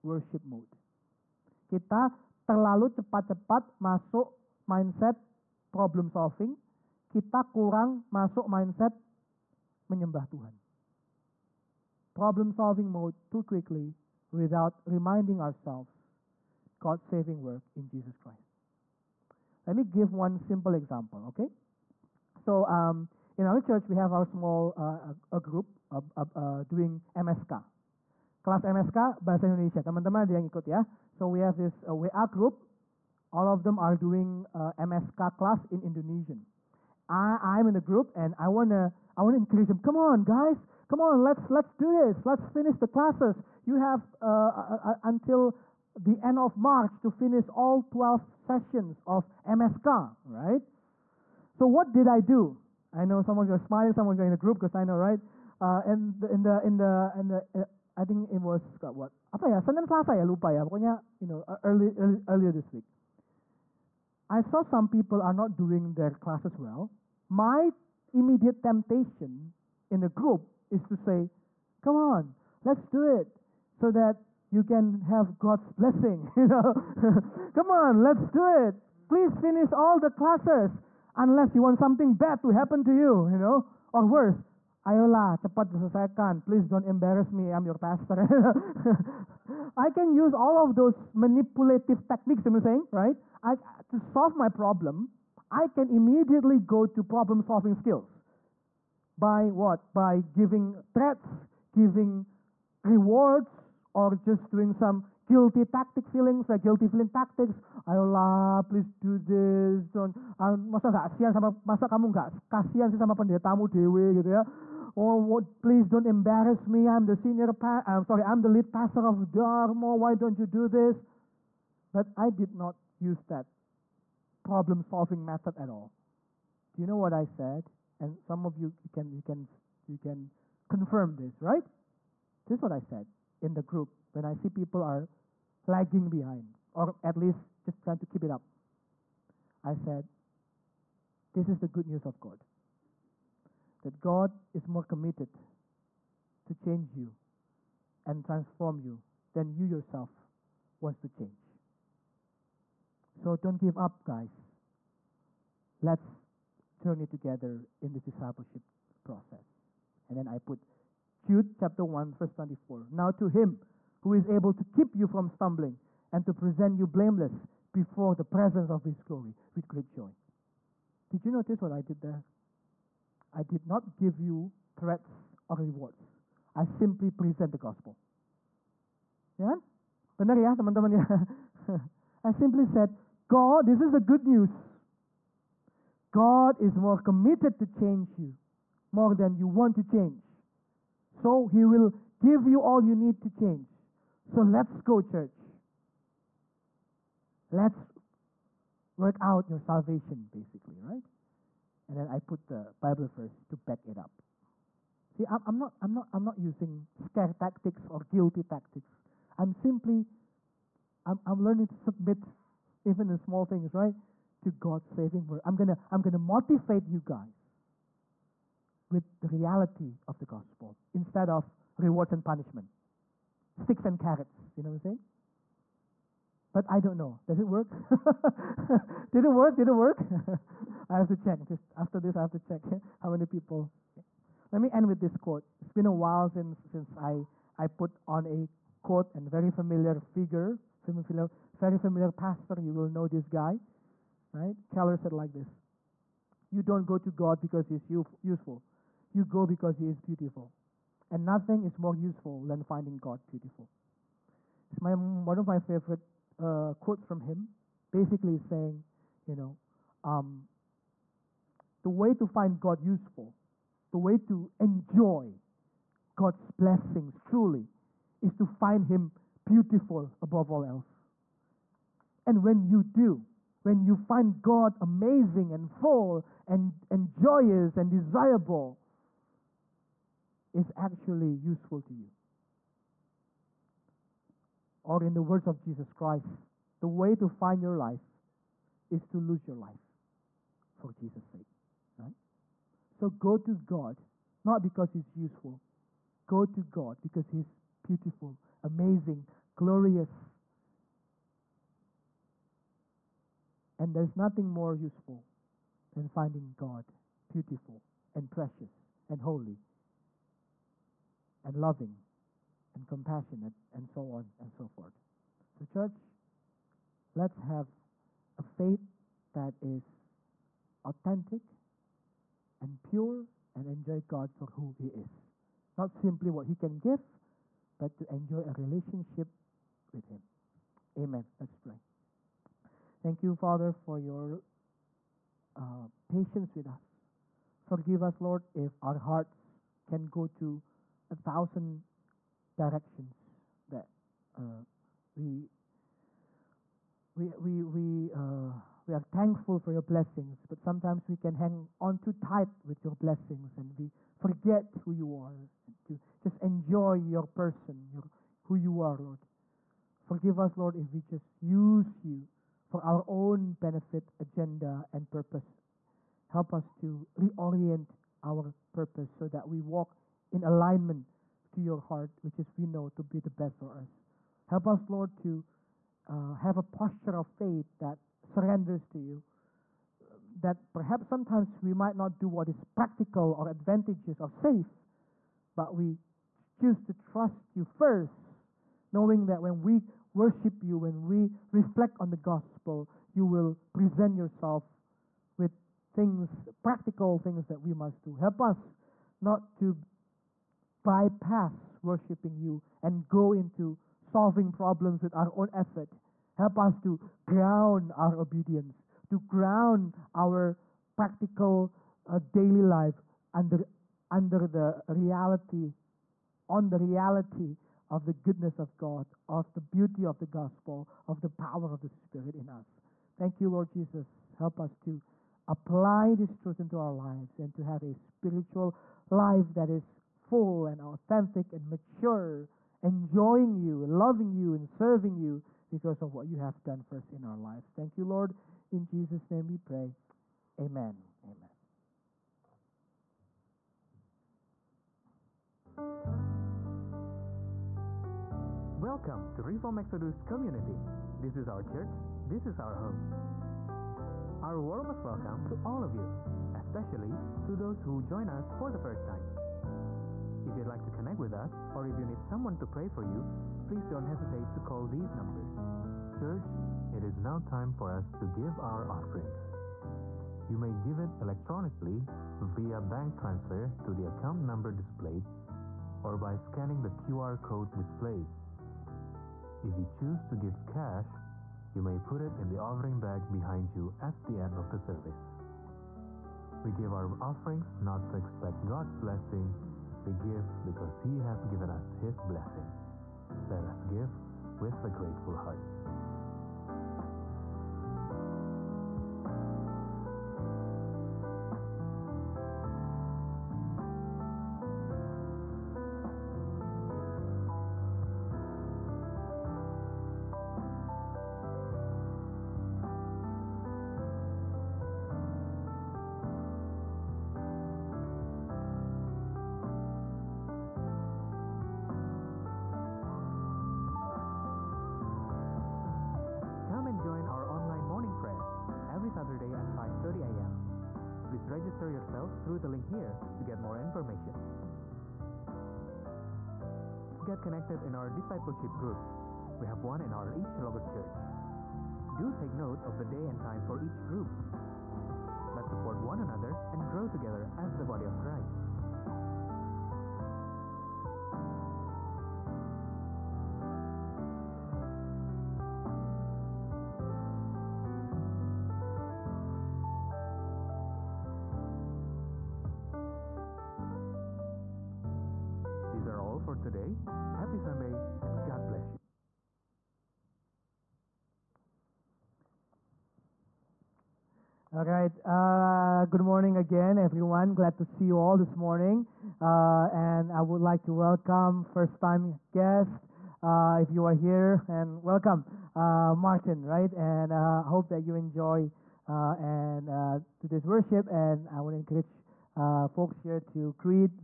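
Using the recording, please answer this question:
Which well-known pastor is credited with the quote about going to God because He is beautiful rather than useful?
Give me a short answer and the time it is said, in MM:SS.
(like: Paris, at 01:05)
Keller, at 04:04.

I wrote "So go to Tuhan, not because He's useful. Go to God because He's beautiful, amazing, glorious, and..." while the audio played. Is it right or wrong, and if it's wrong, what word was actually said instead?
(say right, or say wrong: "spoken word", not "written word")
wrong: "God", not "Tuhan".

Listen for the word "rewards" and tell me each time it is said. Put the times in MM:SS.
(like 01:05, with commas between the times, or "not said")
01:42, 02:55, 03:41.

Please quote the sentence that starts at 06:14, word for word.
Help us, Lord, to uh, have a posture of faith that surrenders to you.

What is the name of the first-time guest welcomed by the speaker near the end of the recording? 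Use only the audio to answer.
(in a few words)
Martin.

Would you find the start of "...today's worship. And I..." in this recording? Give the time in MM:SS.
09:50.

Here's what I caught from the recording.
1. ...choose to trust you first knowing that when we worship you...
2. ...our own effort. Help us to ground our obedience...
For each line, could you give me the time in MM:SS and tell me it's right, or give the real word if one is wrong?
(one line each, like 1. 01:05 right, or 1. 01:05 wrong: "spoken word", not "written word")
1. 06:26 right
2. 06:45 right.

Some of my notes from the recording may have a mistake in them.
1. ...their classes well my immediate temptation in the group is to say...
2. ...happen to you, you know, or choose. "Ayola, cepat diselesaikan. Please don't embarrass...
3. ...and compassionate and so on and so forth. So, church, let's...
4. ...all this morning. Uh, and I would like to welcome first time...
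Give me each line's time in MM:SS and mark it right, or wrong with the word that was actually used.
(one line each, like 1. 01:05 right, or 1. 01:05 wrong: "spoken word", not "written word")
1. 01:05 right
2. 01:22 wrong: "worse", not "choose"
3. 05:12 right
4. 09:38 right.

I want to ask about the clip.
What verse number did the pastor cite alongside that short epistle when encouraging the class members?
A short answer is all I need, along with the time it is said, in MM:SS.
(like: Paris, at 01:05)
24, at 02:42.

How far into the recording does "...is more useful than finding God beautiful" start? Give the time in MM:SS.
04:11.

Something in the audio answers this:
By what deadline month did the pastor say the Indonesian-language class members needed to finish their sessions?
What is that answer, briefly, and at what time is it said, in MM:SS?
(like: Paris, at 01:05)
End of March, at 00:45.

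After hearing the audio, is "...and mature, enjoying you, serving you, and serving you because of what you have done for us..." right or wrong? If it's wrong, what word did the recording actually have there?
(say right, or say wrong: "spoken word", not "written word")
wrong: "loving", not "serving".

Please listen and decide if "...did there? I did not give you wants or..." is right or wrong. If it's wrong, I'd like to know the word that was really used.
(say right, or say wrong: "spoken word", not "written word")
wrong: "threats", not "wants".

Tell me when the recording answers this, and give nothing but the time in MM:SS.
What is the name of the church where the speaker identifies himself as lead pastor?
01:59.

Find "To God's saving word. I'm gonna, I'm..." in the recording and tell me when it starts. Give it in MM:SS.
03:34.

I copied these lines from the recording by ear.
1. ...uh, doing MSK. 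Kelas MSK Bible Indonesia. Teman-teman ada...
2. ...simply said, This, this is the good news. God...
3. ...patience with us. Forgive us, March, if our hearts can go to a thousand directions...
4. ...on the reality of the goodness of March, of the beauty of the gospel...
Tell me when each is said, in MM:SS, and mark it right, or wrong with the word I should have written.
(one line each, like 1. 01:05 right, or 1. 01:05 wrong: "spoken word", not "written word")
1. 00:26 wrong: "Bahasa", not "Bible"
2. 03:02 wrong: "God", not "This"
3. 05:36 wrong: "Lord", not "March"
4. 06:56 wrong: "God", not "March".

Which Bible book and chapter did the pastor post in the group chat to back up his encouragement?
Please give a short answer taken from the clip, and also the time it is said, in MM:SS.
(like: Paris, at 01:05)
Jude 1, at 02:41.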